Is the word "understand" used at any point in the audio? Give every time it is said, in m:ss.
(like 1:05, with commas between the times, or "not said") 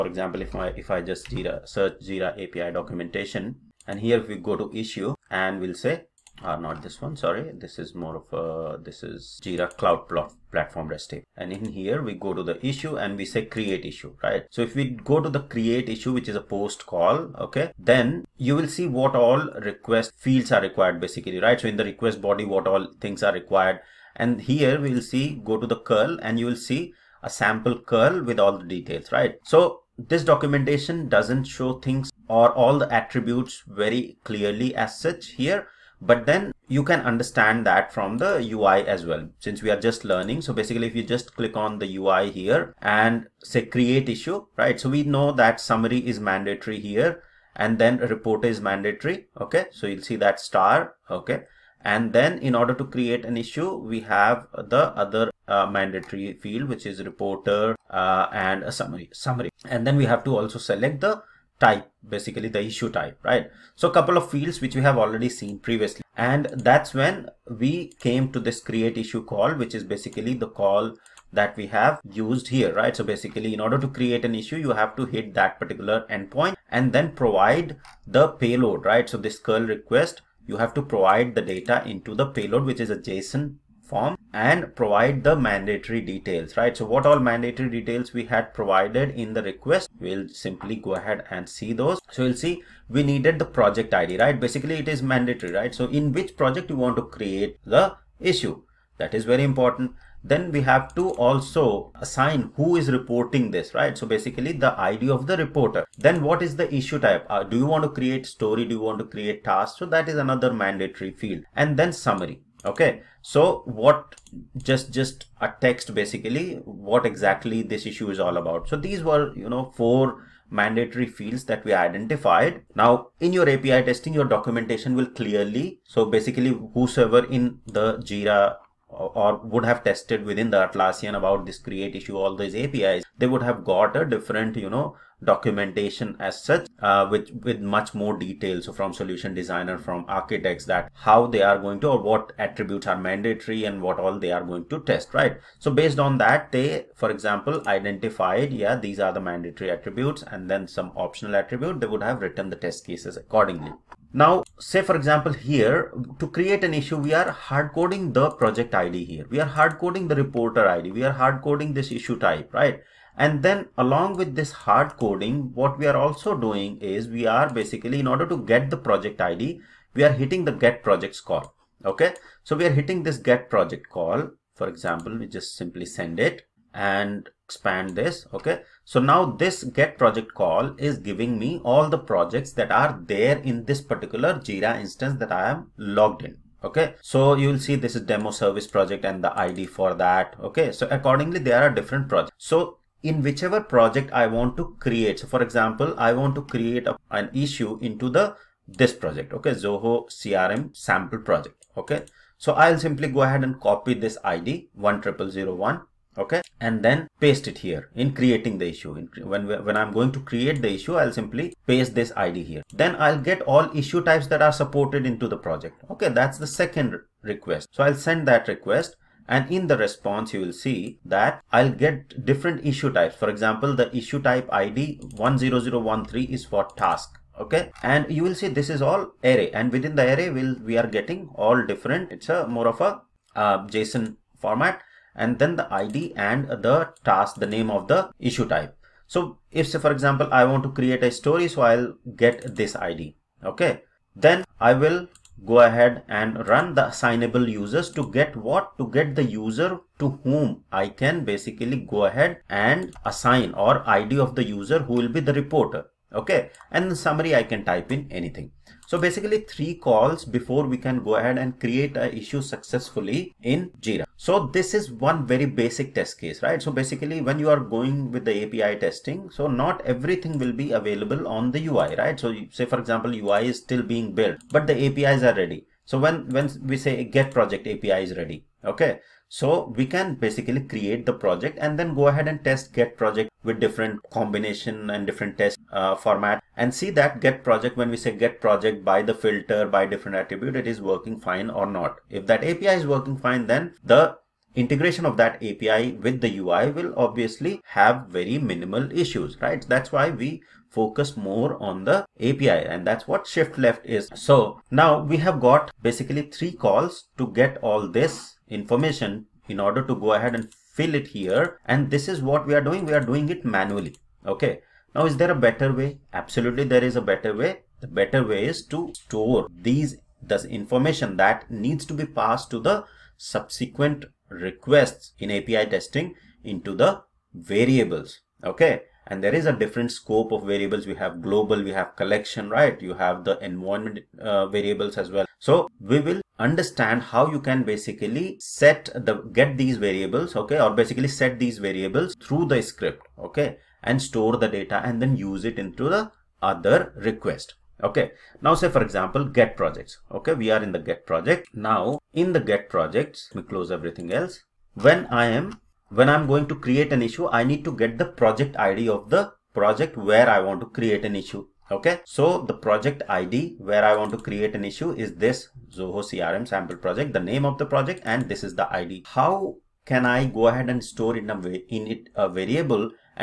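0:37, 5:36.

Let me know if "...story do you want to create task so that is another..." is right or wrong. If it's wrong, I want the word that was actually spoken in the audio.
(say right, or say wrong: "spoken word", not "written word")
right.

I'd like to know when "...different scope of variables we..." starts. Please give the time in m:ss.
5:29.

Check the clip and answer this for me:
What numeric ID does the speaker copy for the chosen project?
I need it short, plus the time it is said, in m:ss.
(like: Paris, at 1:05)
10001, at 3:24.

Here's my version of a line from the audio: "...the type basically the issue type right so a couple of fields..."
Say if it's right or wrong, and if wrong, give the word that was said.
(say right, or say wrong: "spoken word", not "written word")
right.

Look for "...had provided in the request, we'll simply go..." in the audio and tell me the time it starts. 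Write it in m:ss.
1:28.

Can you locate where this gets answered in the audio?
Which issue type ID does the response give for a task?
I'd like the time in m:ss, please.
3:45.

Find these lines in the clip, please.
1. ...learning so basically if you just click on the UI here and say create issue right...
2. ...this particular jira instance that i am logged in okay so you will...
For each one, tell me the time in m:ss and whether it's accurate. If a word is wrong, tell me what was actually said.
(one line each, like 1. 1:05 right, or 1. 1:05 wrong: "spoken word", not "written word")
1. 0:40 right
2. 3:03 right.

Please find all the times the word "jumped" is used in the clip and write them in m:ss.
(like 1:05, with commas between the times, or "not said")
not said.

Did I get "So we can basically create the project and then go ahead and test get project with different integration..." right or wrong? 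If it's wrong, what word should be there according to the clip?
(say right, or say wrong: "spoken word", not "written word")
wrong: "combination", not "integration".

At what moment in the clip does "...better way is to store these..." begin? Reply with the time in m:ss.
5:17.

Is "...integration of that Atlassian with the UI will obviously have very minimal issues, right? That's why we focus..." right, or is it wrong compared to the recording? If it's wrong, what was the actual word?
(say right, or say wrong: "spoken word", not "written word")
wrong: "API", not "Atlassian".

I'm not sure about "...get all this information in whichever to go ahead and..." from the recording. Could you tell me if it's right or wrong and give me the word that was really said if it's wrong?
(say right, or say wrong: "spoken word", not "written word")
wrong: "order", not "whichever".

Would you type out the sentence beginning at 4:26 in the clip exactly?
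So basically when you are going with the API testing, so not everything will be available on the UI, right?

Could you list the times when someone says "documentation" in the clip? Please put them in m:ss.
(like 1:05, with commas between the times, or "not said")
0:02, 0:30, 2:04, 2:15.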